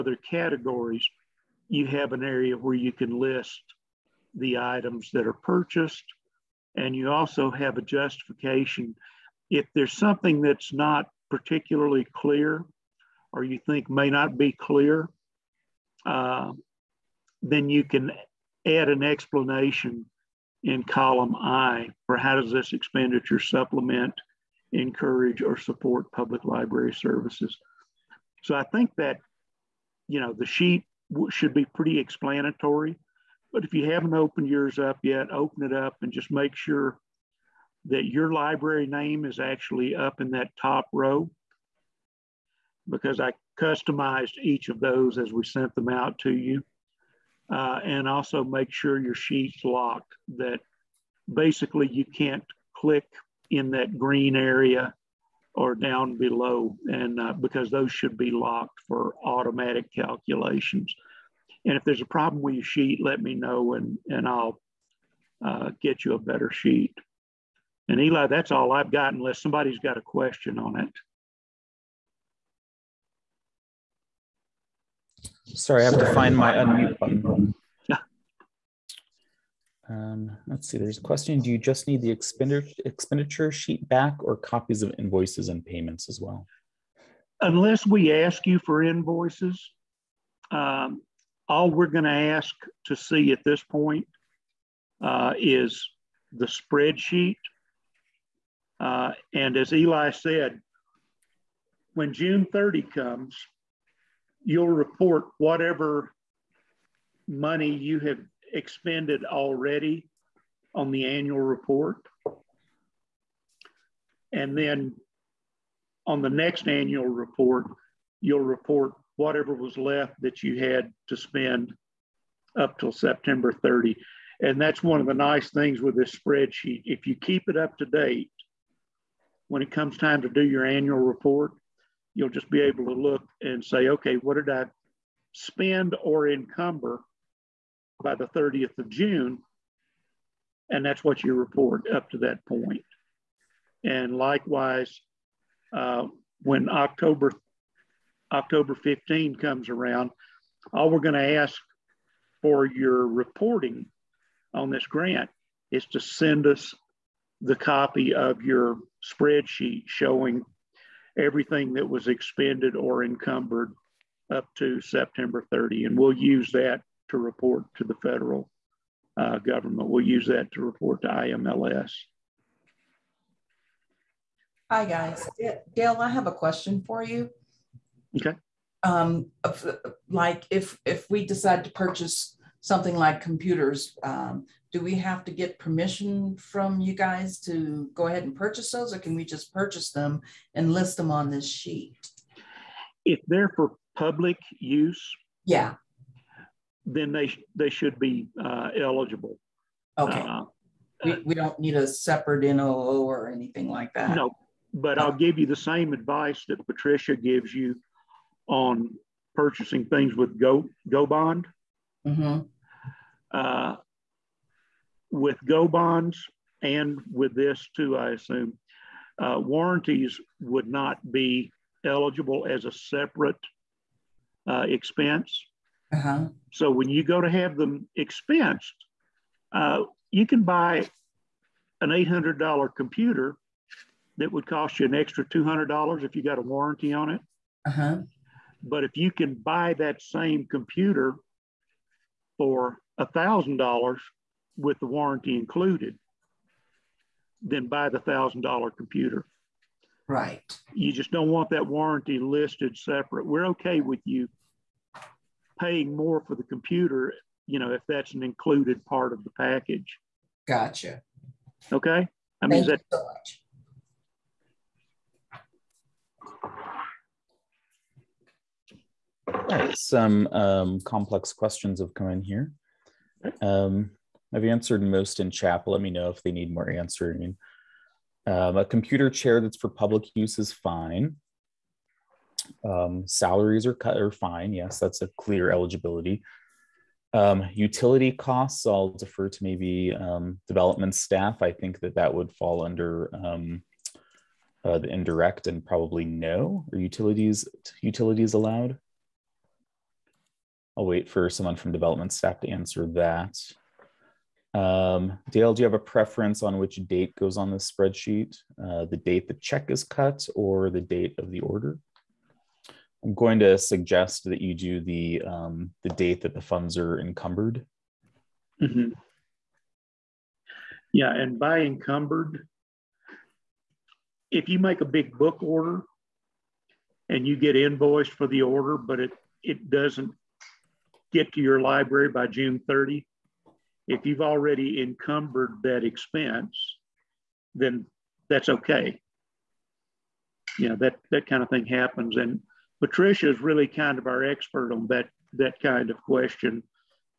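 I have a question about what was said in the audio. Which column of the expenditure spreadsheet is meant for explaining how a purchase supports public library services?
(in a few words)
Column I.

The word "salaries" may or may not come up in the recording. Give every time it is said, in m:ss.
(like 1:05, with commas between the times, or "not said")
4:43.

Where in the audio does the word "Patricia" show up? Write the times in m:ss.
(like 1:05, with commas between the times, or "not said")
3:26, 5:42.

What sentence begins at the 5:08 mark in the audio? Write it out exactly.
Uh, the date the check is cut or the date of the order?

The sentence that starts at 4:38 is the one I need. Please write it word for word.
Um, a computer chair that's for public use is fine.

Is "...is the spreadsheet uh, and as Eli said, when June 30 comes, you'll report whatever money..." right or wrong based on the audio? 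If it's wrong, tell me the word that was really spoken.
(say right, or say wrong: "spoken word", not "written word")
right.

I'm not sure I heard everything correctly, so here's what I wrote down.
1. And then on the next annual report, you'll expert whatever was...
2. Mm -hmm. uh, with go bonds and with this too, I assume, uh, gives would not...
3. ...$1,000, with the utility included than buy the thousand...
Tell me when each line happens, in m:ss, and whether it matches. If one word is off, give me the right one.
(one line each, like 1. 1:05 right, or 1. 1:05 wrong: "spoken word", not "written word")
1. 1:54 wrong: "report", not "expert"
2. 3:32 wrong: "warranties", not "gives"
3. 4:02 wrong: "warranty", not "utility".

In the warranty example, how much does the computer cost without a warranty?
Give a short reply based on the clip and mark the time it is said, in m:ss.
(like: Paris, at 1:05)
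$800, at 3:51.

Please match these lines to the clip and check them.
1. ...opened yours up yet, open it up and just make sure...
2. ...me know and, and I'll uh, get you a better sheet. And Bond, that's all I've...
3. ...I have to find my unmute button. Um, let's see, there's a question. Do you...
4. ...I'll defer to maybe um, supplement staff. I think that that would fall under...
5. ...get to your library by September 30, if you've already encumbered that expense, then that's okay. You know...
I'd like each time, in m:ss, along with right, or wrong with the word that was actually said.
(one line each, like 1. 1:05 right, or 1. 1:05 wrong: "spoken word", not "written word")
1. 0:34 right
2. 1:03 wrong: "Eli", not "Bond"
3. 1:15 right
4. 4:48 wrong: "development", not "supplement"
5. 5:31 wrong: "June", not "September".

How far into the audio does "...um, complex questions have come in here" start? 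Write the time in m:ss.
4:30.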